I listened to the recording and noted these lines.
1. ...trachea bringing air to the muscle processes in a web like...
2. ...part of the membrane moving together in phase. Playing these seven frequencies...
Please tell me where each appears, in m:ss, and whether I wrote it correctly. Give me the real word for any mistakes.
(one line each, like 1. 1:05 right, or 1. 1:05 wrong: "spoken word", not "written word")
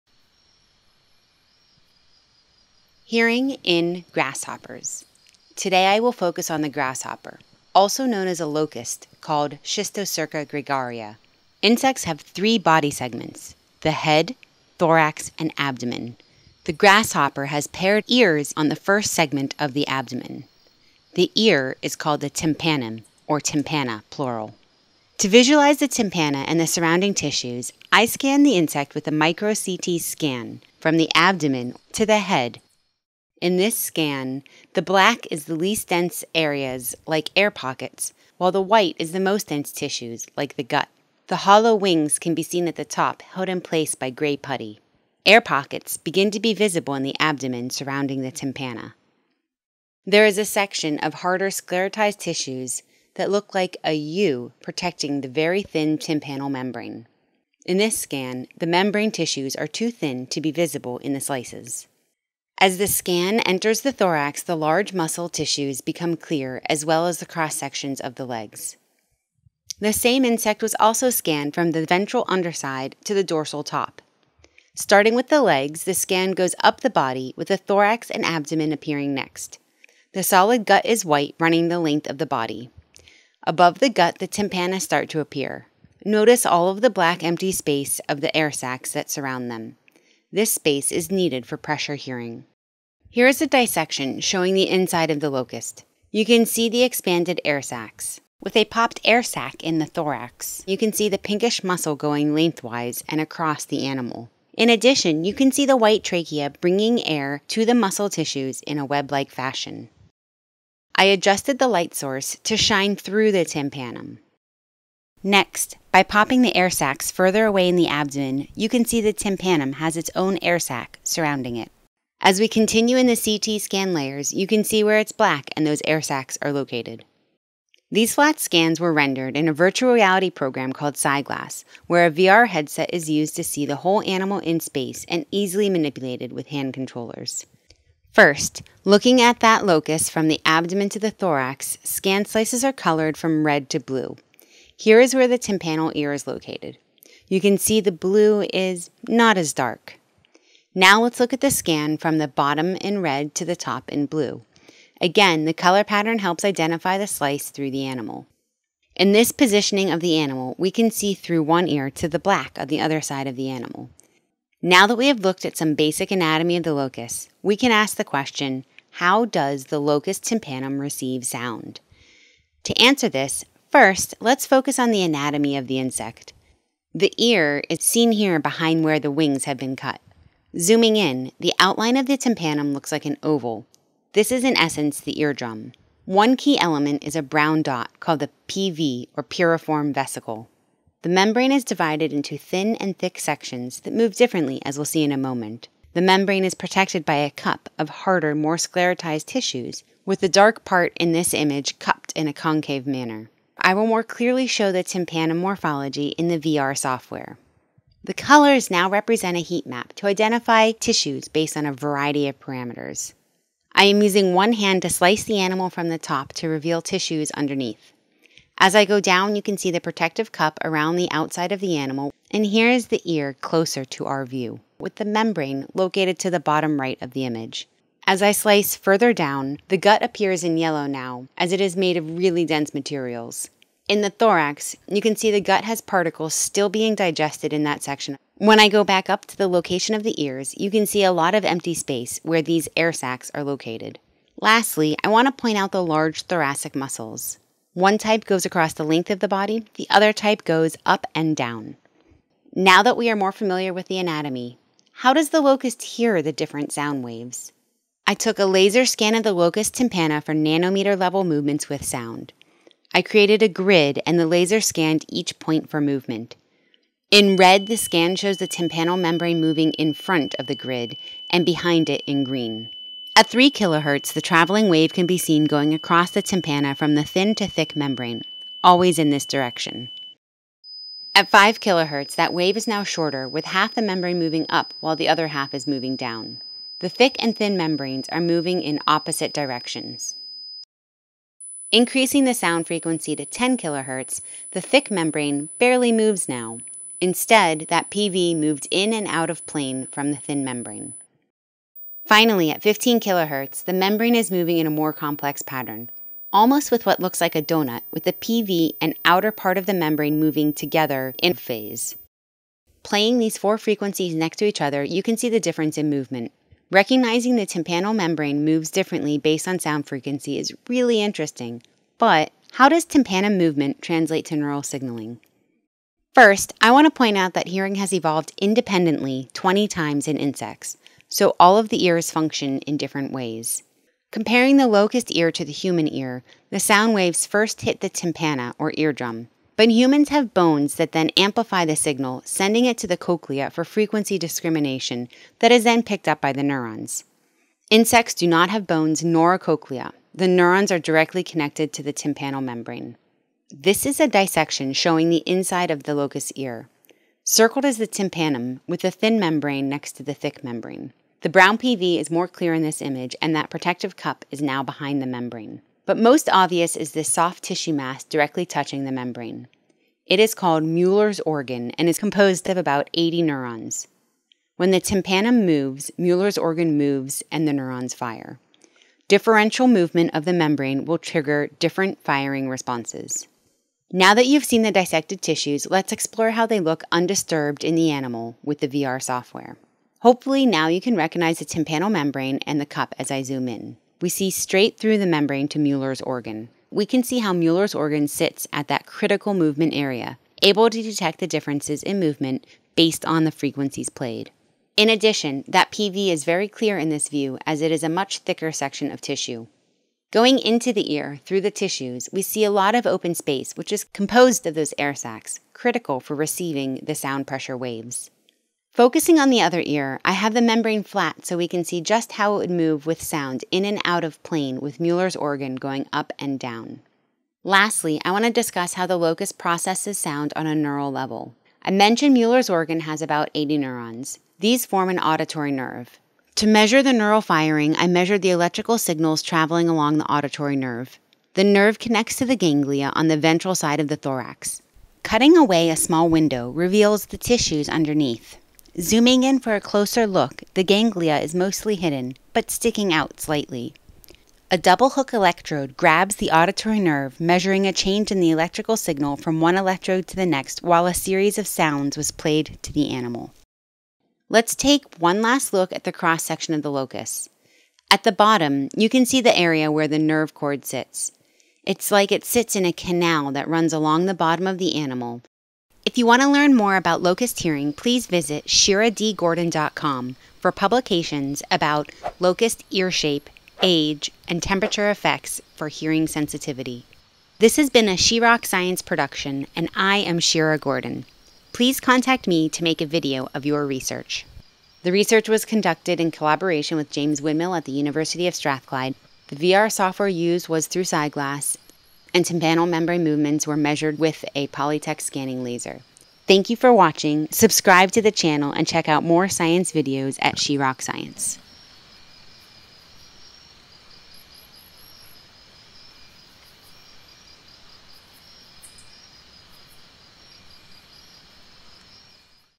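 1. 1:46 wrong: "tissues", not "processes"
2. 5:09 wrong: "four", not "seven".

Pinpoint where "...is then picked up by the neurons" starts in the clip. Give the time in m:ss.
5:45.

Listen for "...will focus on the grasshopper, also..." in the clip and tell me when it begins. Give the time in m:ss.
0:05.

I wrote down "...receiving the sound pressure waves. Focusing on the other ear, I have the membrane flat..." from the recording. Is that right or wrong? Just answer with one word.
right.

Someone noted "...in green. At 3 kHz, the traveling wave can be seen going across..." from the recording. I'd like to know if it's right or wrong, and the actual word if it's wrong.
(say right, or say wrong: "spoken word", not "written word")
right.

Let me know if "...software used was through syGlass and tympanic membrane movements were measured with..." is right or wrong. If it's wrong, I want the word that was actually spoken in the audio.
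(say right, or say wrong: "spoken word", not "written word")
right.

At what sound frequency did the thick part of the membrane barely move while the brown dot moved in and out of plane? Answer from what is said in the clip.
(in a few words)
10 kHz.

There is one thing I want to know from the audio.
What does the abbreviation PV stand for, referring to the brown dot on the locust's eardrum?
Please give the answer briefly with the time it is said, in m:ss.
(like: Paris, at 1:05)
Piriform vesicle, at 3:09.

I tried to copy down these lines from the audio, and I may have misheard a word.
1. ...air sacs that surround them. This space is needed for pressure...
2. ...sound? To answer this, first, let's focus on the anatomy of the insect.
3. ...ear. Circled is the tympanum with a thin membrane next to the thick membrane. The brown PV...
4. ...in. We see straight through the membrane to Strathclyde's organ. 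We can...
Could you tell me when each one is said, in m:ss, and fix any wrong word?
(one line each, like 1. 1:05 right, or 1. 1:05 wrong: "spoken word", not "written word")
1. 1:28 right
2. 2:51 right
3. 5:56 right
4. 6:33 wrong: "Müller", not "Strathclyde".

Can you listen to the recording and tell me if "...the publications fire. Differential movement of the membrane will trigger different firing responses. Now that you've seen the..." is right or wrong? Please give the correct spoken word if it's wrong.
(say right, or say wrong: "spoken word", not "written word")
wrong: "neurons", not "publications".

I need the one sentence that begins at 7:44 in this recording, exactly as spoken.
Let's take one last look at the cross section of the locust.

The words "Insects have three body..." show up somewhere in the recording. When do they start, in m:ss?
0:11.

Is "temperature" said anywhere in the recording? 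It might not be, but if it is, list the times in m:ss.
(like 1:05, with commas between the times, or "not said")
8:04.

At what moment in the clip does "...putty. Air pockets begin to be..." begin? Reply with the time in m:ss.
0:44.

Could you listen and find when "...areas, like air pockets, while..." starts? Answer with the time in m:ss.
0:36.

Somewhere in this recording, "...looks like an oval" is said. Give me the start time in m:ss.
3:02.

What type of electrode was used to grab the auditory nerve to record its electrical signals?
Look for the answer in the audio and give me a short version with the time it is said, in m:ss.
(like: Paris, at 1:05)
Double hook electrode, at 7:34.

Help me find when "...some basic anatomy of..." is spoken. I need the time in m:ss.
2:45.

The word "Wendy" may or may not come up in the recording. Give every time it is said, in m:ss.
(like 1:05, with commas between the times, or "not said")
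not said.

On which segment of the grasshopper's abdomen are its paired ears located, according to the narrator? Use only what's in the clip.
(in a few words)
First segment.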